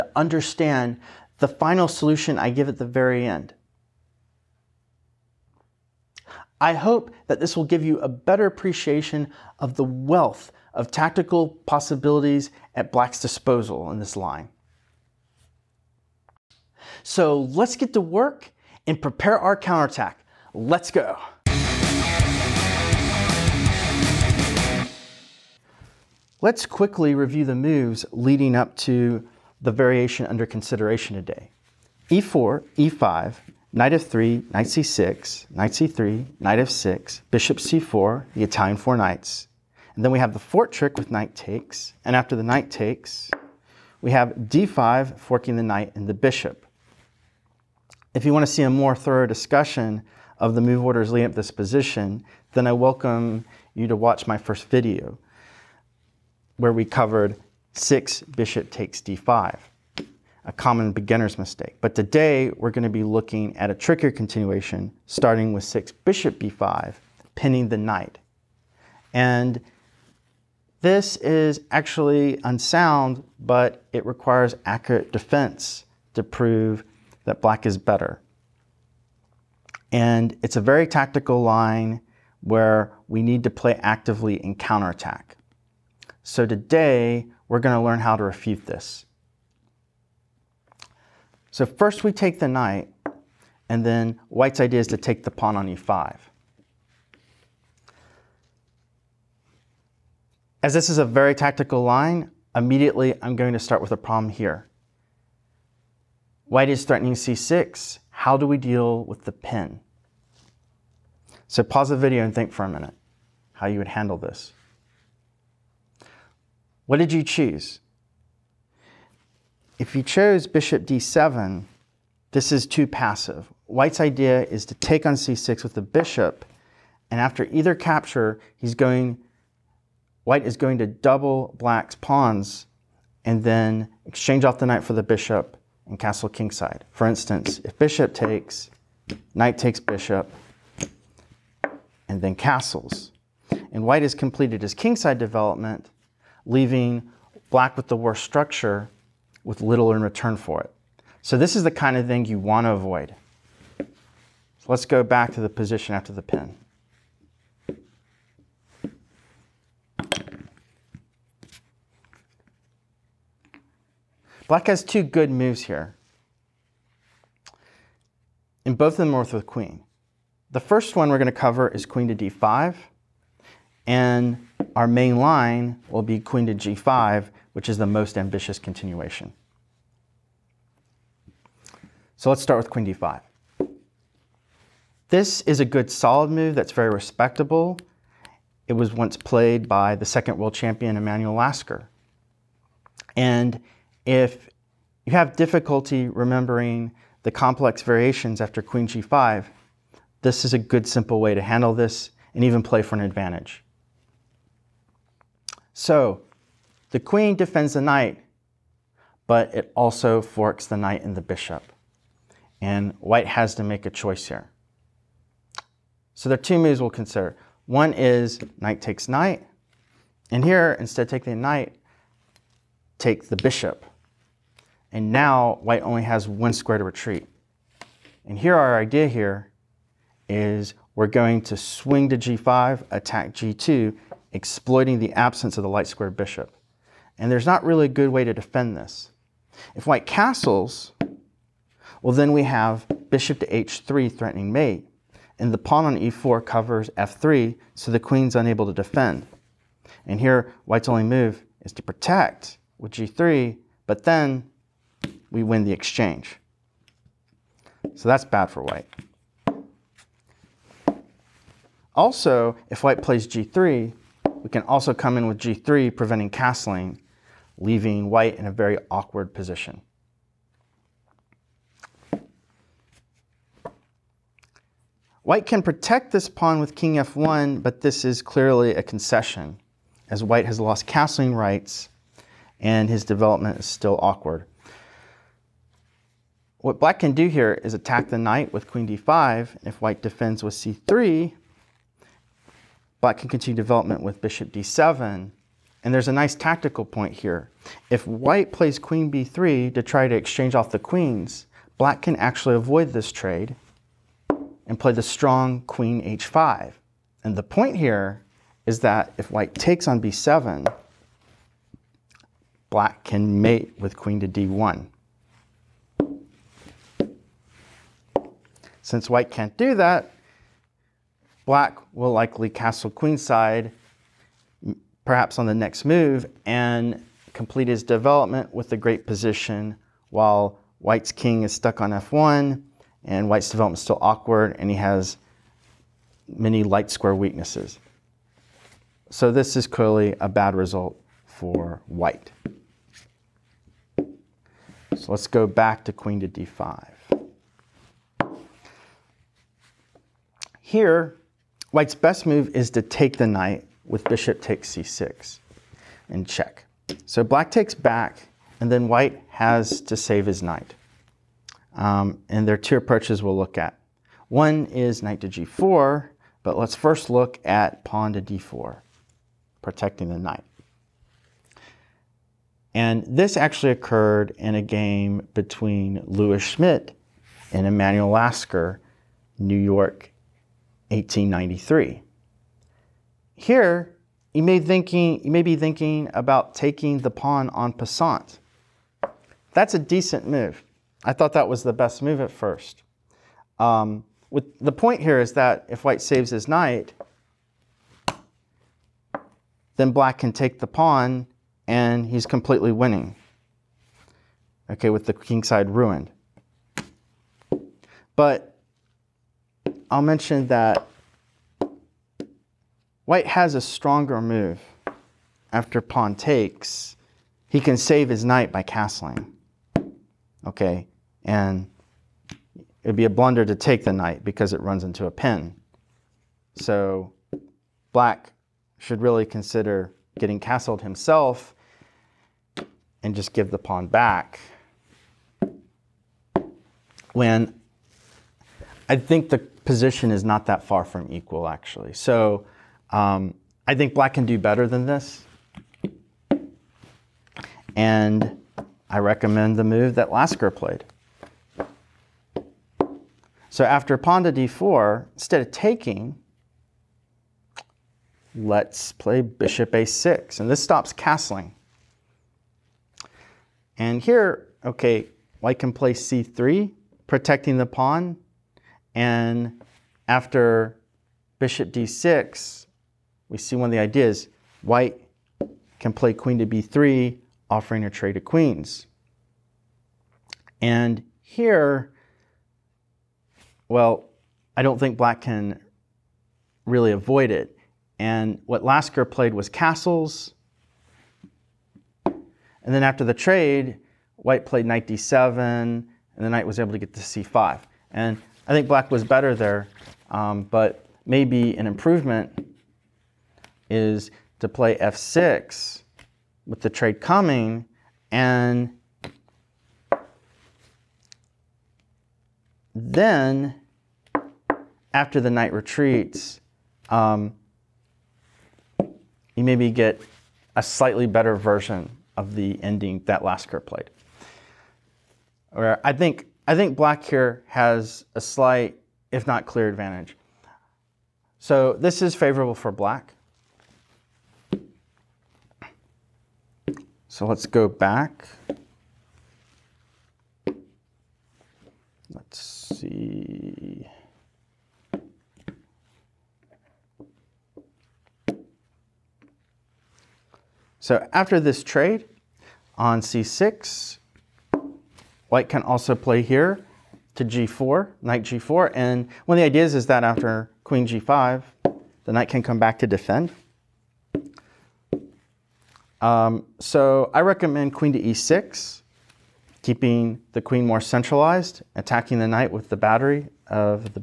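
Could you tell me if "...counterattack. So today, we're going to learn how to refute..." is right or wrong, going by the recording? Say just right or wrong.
right.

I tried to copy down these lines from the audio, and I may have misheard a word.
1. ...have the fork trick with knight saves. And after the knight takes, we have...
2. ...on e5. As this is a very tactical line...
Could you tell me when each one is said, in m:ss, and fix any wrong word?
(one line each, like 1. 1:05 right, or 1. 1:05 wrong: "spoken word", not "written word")
1. 0:40 wrong: "takes", not "saves"
2. 1:35 right.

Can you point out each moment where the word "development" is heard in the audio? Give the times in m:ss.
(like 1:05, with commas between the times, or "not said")
2:25, 4:43, 4:53, 5:27, 5:33.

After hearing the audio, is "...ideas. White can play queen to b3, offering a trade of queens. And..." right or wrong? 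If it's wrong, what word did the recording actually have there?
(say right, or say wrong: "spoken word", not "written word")
right.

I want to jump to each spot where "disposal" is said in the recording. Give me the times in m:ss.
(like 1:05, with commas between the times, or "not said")
0:13.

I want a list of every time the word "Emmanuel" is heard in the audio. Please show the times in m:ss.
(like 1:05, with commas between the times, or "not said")
3:10, 6:17.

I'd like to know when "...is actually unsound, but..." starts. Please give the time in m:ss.
1:11.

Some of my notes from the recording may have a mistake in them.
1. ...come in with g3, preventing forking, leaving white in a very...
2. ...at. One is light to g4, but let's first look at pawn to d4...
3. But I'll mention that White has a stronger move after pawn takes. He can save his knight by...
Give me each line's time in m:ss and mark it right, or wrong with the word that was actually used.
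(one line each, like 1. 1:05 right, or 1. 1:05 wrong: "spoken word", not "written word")
1. 4:24 wrong: "castling", not "forking"
2. 6:03 wrong: "knight", not "light"
3. 6:48 right.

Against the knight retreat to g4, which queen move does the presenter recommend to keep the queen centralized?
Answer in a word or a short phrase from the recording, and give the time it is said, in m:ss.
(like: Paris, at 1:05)
Queen to e6, at 9:27.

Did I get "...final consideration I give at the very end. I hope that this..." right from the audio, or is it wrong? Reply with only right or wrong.
wrong.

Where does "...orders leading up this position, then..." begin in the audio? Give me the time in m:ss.
0:50.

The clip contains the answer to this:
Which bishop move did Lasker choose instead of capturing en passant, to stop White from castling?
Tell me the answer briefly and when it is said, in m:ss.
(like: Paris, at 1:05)
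Bishop a6, at 7:39.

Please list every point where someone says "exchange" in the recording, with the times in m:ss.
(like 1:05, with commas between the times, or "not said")
2:14, 4:15, 5:00.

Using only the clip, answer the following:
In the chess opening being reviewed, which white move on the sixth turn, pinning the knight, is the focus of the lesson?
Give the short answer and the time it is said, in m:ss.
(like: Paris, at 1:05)
Bishop b5, at 1:05.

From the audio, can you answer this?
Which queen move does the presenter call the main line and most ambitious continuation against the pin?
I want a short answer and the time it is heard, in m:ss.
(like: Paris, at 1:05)
Queen to g5, at 2:56.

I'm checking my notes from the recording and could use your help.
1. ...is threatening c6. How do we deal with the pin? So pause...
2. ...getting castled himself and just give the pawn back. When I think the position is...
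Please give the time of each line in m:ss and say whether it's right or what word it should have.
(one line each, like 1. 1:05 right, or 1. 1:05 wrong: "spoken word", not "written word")
1. 1:46 right
2. 7:10 right.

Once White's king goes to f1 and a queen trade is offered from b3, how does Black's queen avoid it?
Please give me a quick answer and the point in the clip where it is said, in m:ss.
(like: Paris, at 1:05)
Queen h5, at 5:05.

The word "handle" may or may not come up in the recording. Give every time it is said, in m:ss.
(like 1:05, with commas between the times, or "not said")
1:53, 3:21.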